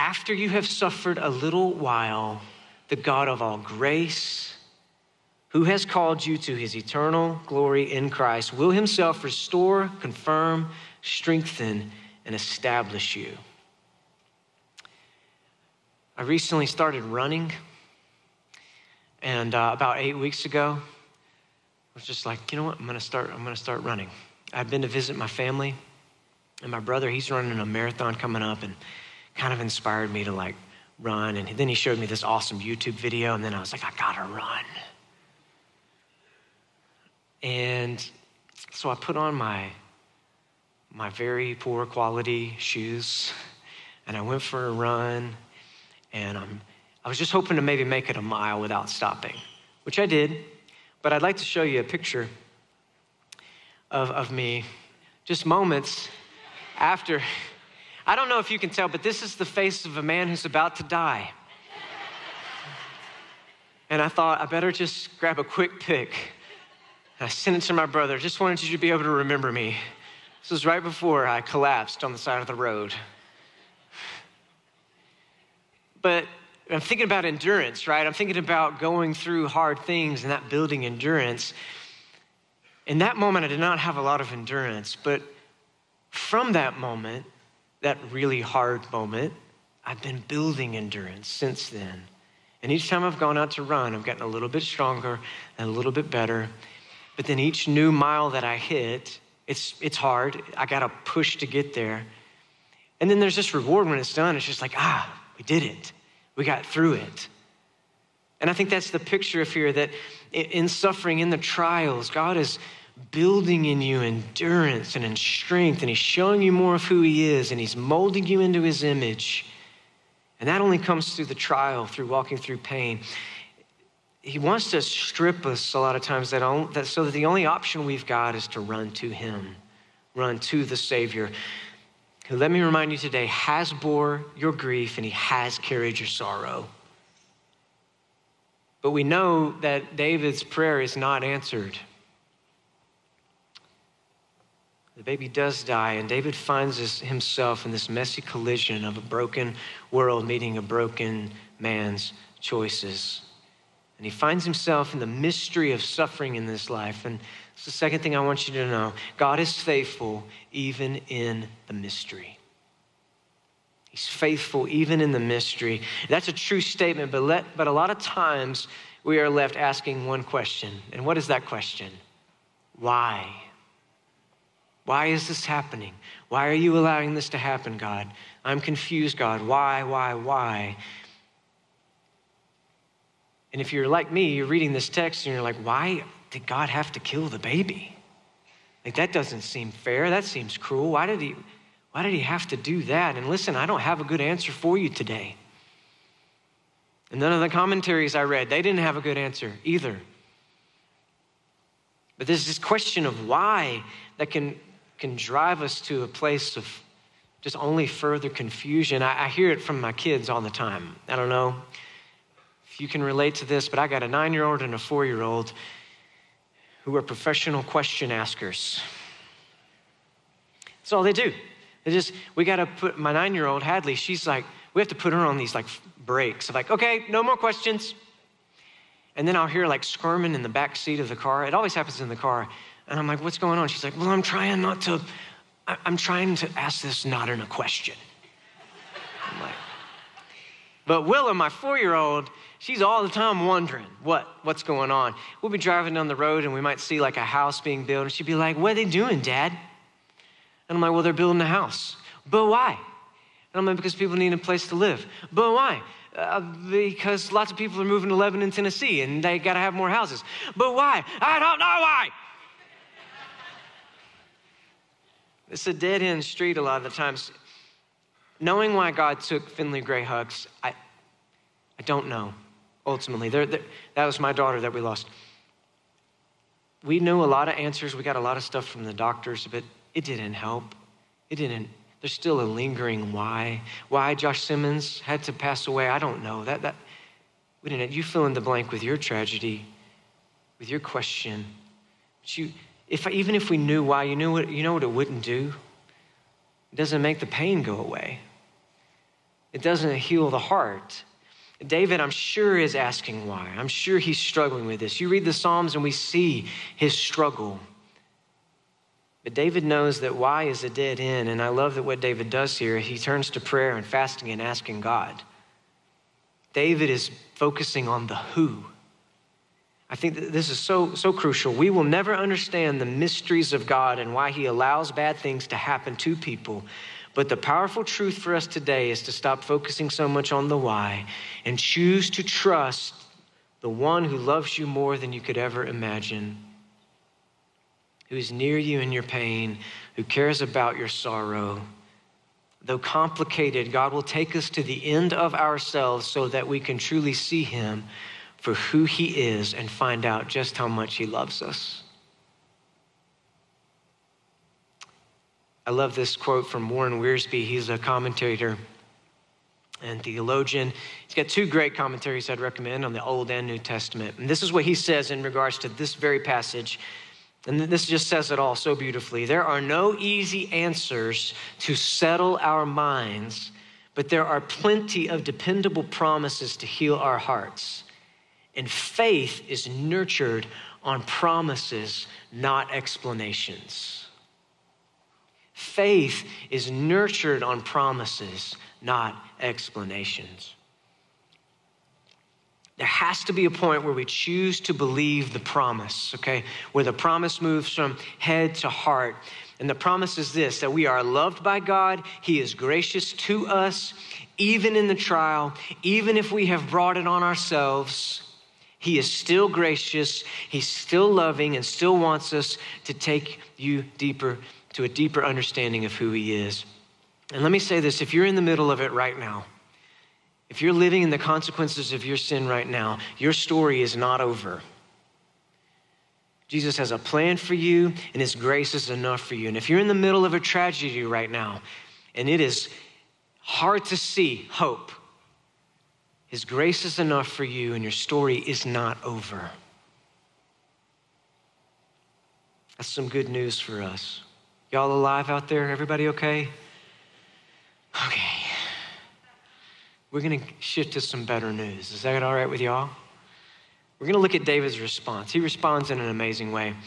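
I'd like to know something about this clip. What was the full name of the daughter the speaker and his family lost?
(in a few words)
Finley Gray Hucks.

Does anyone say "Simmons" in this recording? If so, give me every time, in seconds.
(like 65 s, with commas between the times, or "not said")
284 s.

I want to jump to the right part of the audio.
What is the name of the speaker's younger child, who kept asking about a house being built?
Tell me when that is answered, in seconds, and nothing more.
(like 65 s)
241 s.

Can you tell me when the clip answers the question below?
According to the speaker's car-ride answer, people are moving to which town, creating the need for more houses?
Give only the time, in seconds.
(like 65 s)
258 s.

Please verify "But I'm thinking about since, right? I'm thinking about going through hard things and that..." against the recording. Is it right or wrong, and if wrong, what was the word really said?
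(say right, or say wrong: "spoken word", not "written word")
wrong: "endurance", not "since".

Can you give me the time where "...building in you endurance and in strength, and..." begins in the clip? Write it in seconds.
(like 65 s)
113 s.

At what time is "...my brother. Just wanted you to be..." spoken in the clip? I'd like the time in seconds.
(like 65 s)
67 s.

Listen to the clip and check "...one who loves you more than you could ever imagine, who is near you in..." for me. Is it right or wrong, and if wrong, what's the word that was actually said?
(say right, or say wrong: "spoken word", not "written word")
right.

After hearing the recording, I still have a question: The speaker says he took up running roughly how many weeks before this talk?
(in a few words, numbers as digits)
8.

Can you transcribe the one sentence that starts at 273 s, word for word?
They're, they're, that was my daughter that we lost.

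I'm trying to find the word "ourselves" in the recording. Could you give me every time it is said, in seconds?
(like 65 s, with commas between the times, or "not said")
345 s, 407 s.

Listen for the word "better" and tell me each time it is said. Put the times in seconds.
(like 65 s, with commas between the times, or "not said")
64 s, 96 s, 451 s.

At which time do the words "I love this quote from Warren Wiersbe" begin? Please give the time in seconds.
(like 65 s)
355 s.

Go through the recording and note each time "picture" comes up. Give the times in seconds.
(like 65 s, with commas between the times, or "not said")
51 s, 108 s.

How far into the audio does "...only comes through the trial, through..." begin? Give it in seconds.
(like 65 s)
120 s.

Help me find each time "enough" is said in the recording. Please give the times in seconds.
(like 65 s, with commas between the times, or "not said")
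428 s, 436 s.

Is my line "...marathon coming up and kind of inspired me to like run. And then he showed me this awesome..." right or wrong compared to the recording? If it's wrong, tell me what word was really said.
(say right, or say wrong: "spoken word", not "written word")
right.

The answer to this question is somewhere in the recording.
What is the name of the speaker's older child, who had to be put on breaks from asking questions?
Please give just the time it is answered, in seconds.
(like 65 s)
223 s.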